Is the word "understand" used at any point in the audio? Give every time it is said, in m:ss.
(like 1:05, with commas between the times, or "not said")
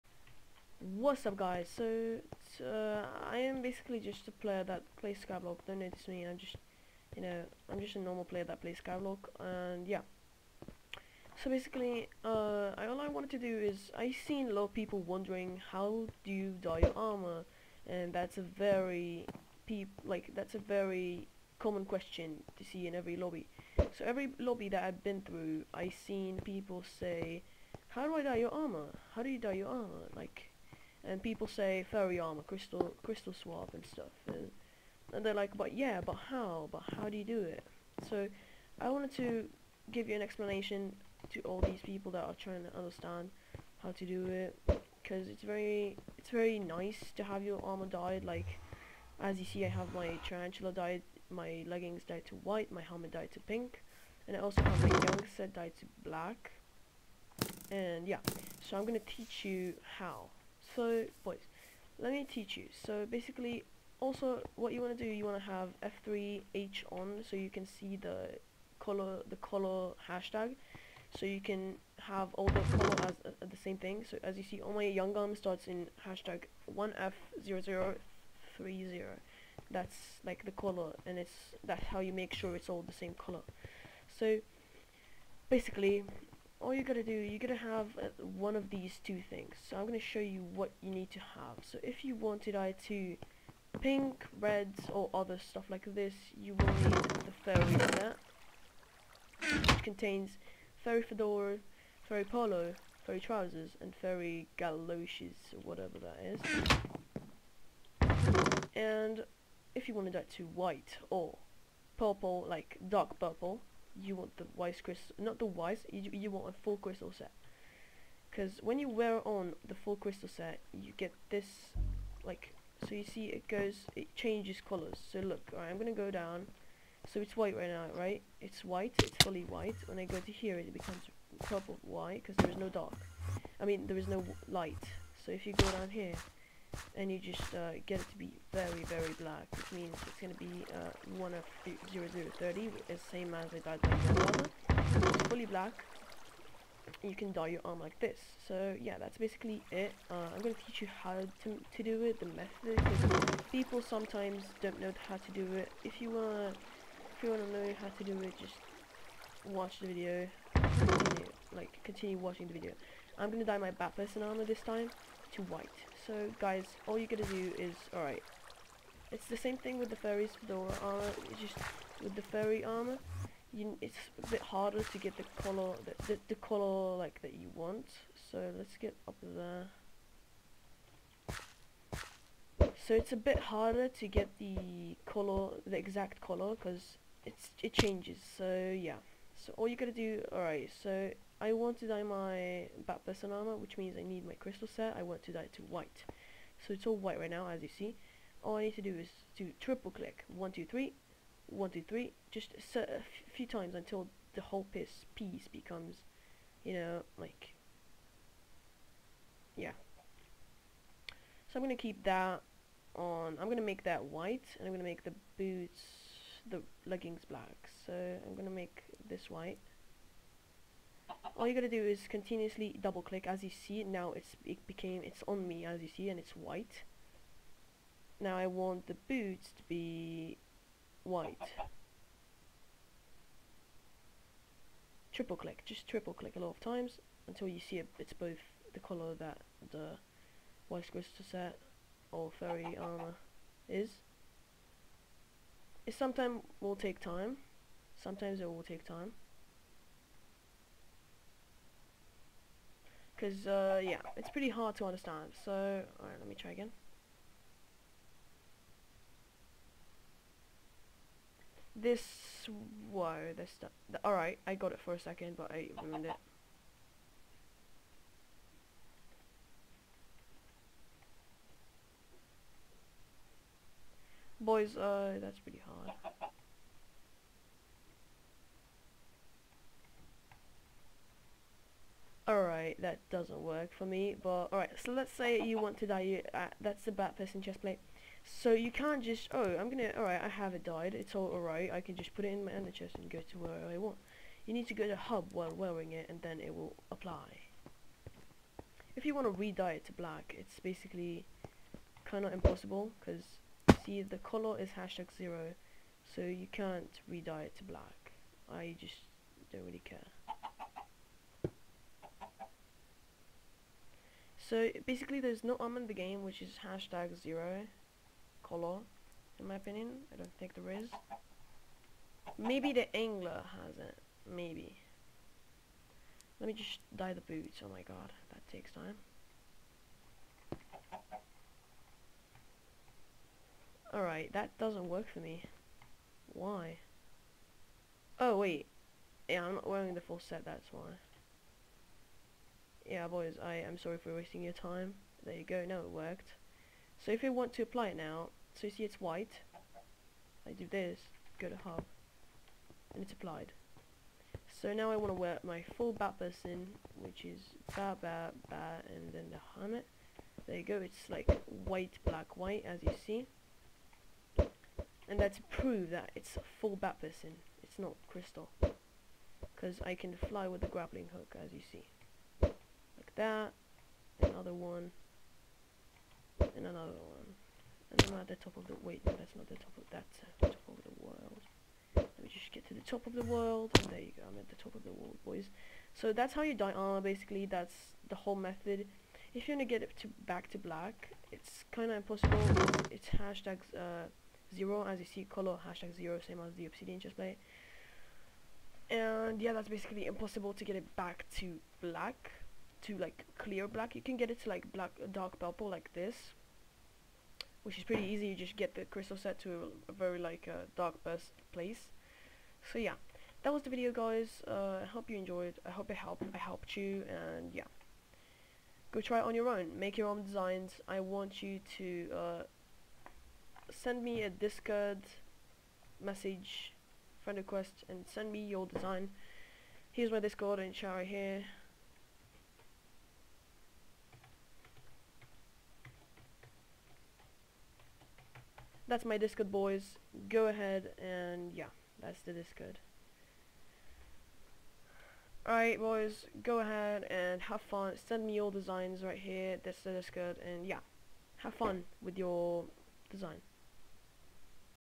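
0:42, 4:14.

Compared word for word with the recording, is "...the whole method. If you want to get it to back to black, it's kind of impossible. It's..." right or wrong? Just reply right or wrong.
right.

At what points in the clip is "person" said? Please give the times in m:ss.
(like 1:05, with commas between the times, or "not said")
2:43, 3:13, 4:47, 5:56, 6:06.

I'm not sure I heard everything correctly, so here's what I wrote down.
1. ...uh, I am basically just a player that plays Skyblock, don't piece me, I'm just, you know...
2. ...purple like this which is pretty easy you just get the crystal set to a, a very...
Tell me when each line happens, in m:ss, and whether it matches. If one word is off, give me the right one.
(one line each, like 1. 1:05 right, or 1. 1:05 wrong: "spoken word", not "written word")
1. 0:02 wrong: "notice", not "piece"
2. 6:45 right.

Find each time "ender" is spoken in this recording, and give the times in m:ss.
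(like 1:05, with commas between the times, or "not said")
4:52.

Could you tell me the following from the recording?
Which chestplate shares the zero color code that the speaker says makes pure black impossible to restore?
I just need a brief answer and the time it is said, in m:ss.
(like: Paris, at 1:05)
Obsidian chestplate, at 6:36.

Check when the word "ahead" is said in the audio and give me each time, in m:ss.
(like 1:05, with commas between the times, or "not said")
7:20, 7:26.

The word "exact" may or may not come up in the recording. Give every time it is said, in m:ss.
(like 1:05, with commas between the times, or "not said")
3:05.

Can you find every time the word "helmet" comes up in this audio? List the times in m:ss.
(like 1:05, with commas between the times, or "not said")
0:52, 5:59.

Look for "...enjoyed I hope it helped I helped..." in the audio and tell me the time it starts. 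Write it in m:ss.
6:55.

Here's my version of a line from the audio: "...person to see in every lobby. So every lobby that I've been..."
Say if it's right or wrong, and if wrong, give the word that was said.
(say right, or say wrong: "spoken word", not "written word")
wrong: "question", not "person".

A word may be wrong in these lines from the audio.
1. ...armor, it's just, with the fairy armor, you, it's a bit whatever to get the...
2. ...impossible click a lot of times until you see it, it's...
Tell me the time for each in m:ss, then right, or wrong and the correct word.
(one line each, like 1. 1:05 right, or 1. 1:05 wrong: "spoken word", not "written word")
1. 2:50 wrong: "harder", not "whatever"
2. 3:55 wrong: "triple", not "impossible".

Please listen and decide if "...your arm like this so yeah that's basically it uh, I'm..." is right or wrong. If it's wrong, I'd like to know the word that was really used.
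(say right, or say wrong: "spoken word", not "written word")
right.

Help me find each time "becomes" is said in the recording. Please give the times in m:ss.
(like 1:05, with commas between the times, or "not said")
2:10, 3:25.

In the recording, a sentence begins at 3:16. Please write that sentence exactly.
So it's all white right now, as you see.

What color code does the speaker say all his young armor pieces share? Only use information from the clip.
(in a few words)
#1F0030.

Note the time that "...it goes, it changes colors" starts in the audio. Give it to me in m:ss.
2:03.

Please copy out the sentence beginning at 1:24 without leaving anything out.
So basically, all you gotta do, you gotta have uh, one of these two things.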